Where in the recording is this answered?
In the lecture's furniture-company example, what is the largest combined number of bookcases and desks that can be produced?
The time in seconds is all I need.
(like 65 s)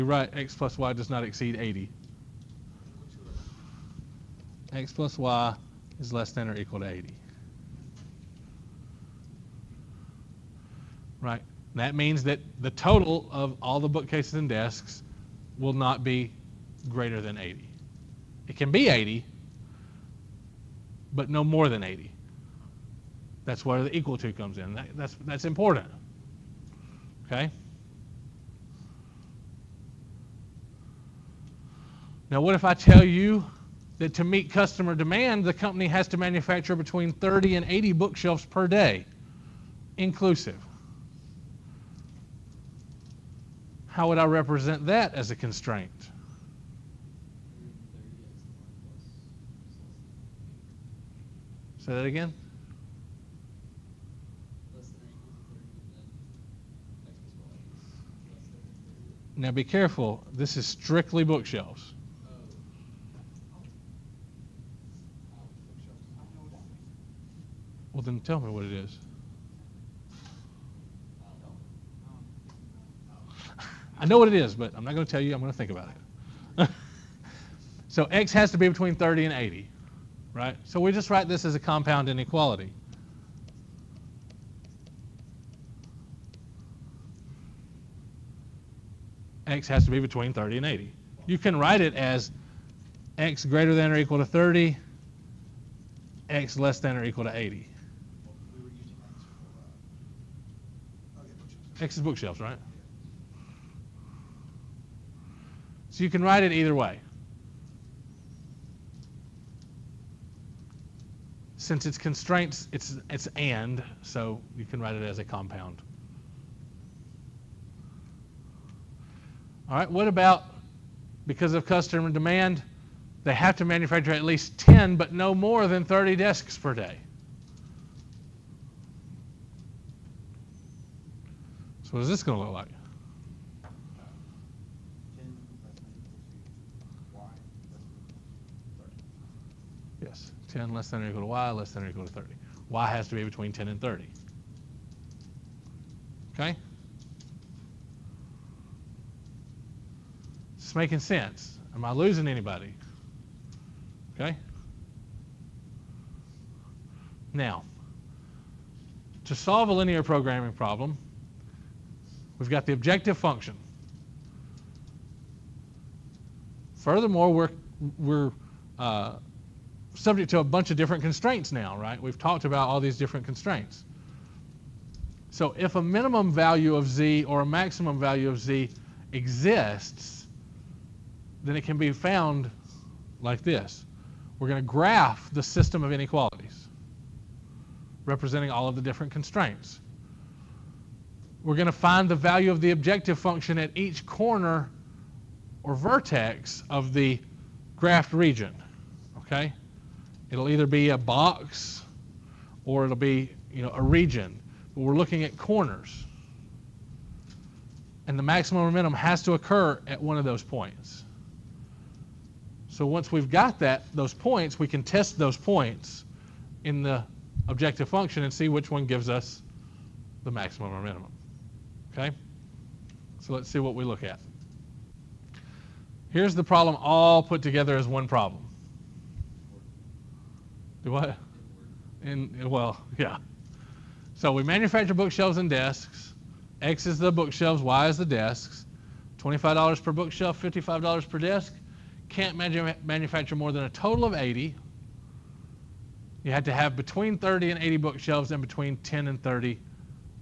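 4 s.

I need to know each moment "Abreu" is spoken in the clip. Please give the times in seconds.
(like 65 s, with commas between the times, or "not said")
not said.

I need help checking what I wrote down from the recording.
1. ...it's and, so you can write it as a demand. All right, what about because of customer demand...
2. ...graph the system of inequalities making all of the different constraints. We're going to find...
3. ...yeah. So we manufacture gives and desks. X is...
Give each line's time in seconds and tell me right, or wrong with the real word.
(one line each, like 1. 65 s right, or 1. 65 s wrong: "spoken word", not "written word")
1. 113 s wrong: "compound", not "demand"
2. 184 s wrong: "representing", not "making"
3. 232 s wrong: "bookshelves", not "gives".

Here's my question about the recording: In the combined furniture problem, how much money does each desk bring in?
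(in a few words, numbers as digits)
$55.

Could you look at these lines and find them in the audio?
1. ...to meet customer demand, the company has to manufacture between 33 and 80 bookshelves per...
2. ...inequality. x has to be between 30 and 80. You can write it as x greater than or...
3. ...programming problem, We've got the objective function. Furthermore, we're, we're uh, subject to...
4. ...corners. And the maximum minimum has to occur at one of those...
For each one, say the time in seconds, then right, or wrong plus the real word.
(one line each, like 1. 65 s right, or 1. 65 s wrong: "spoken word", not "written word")
1. 34 s wrong: "30", not "33"
2. 82 s right
3. 160 s right
4. 205 s wrong: "momentum", not "minimum".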